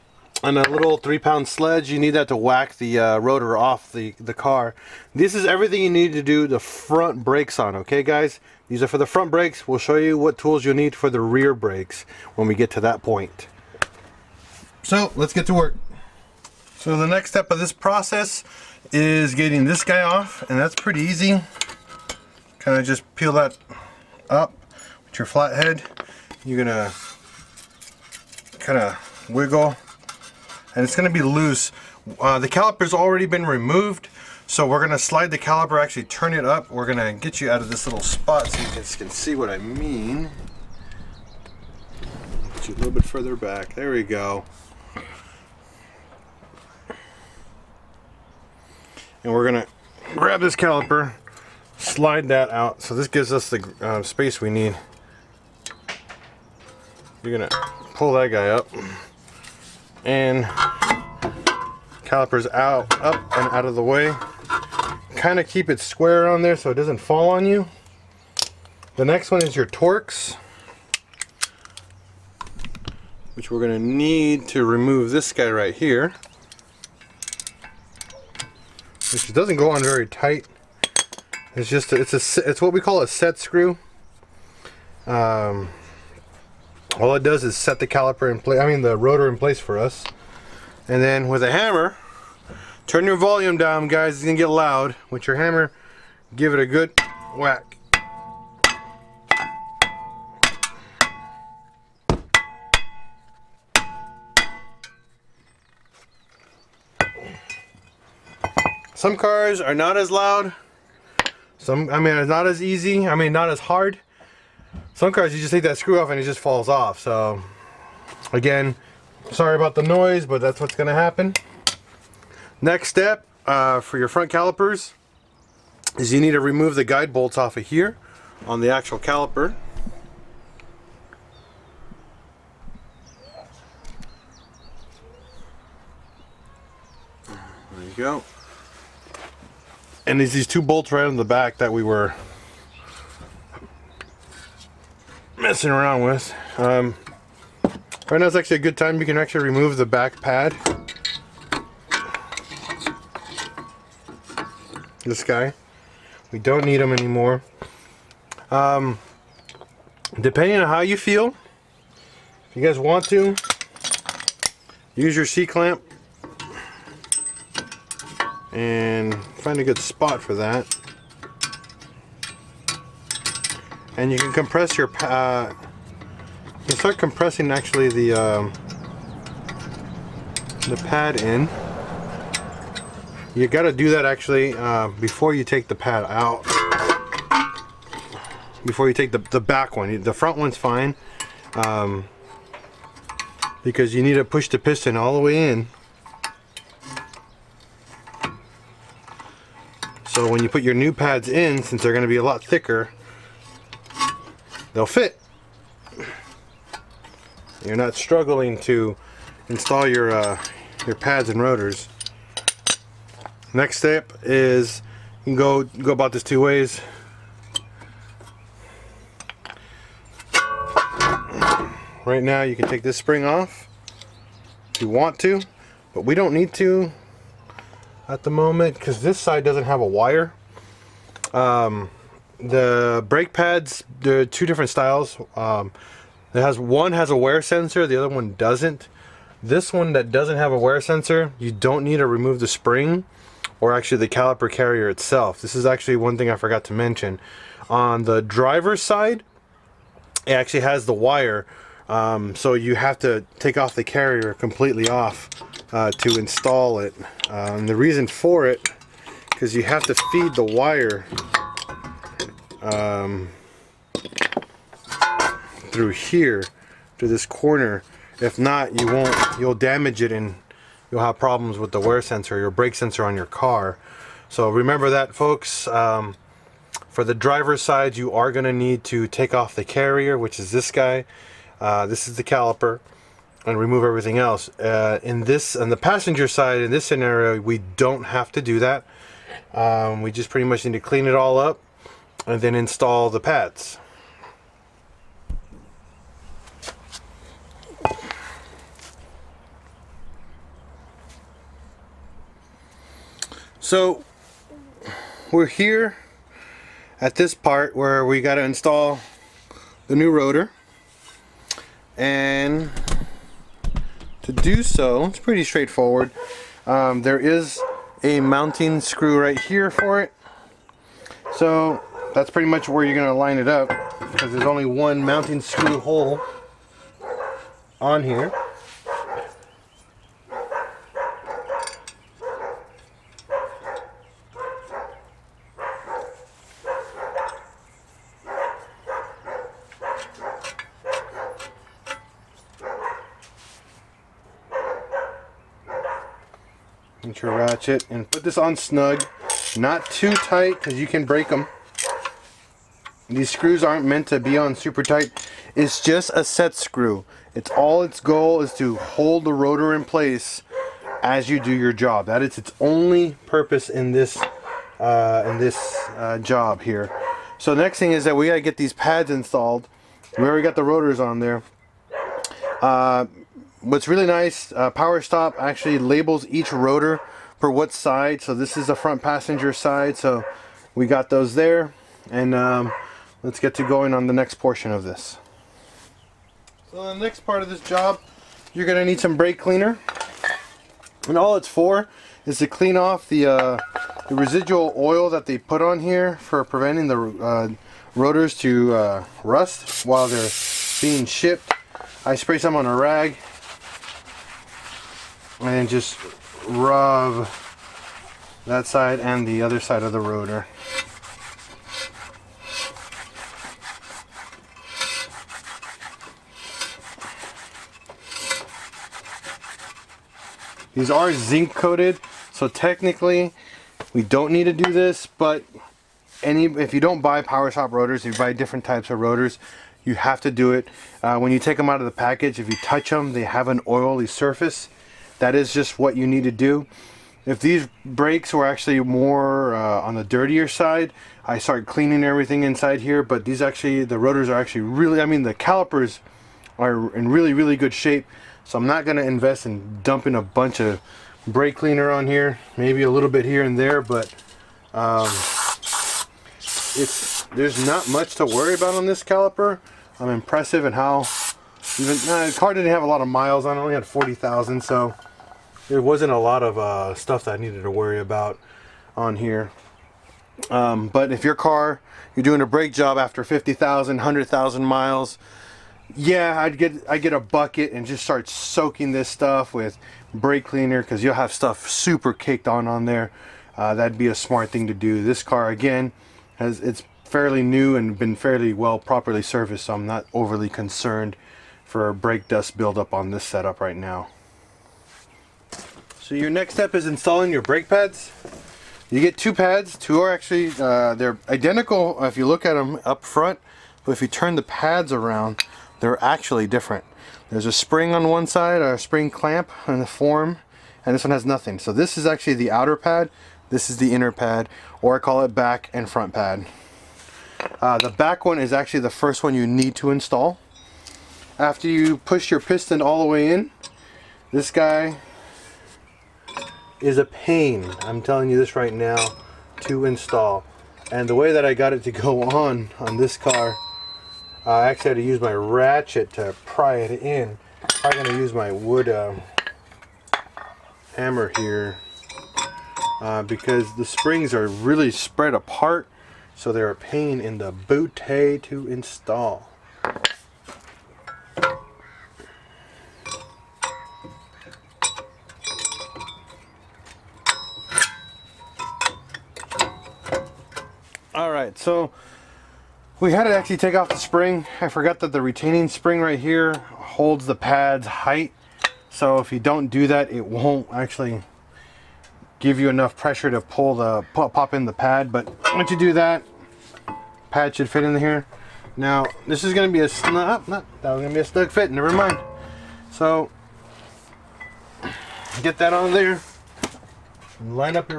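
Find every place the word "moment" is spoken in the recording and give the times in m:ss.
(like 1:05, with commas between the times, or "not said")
3:48.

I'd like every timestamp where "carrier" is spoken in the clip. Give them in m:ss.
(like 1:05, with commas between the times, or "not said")
4:04, 4:13, 4:39.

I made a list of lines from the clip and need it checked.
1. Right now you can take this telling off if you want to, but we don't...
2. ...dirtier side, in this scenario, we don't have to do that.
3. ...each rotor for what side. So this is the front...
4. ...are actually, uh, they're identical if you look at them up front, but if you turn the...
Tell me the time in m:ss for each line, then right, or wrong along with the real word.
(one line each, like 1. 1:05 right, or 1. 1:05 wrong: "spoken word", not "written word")
1. 3:42 wrong: "spring", not "telling"
2. 4:45 wrong: "passenger", not "dirtier"
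3. 6:16 right
4. 8:20 right.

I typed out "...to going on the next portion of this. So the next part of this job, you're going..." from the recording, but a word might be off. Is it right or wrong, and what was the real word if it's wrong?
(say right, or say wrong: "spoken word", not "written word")
right.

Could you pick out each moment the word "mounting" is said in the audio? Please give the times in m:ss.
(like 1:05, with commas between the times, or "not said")
5:18, 5:25.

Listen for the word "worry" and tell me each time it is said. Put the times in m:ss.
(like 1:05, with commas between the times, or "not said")
7:38, 7:47.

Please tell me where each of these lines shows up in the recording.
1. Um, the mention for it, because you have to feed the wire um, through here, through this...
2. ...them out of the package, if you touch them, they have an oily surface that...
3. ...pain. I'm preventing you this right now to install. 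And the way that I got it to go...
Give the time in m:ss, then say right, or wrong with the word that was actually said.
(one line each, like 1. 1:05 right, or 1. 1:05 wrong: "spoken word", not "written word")
1. 4:17 wrong: "reason", not "mention"
2. 7:11 right
3. 8:47 wrong: "telling", not "preventing".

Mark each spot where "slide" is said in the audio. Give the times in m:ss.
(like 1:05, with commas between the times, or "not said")
0:34, 0:51.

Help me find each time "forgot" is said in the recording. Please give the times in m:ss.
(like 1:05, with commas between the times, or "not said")
4:06, 9:24.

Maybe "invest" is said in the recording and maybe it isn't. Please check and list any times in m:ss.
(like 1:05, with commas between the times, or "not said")
7:29.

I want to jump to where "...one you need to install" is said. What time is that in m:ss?
8:39.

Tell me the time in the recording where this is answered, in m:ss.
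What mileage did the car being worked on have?
7:43.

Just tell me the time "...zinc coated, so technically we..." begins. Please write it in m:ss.
7:01.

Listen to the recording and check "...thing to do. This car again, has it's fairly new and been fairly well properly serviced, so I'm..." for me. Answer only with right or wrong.
right.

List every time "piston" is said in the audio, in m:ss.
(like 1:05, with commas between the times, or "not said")
3:14, 8:42.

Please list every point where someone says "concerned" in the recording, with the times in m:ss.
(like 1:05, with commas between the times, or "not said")
8:10.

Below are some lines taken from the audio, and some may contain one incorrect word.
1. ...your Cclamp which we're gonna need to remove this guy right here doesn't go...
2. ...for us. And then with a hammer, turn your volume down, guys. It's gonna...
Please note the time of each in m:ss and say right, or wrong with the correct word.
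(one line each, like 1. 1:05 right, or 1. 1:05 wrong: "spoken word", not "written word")
1. 1:09 wrong: "Torx", not "Cclamp"
2. 1:29 right.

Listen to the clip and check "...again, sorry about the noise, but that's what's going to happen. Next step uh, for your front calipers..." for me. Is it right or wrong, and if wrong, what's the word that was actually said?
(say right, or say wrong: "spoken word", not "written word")
right.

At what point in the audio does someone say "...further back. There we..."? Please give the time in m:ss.
0:43.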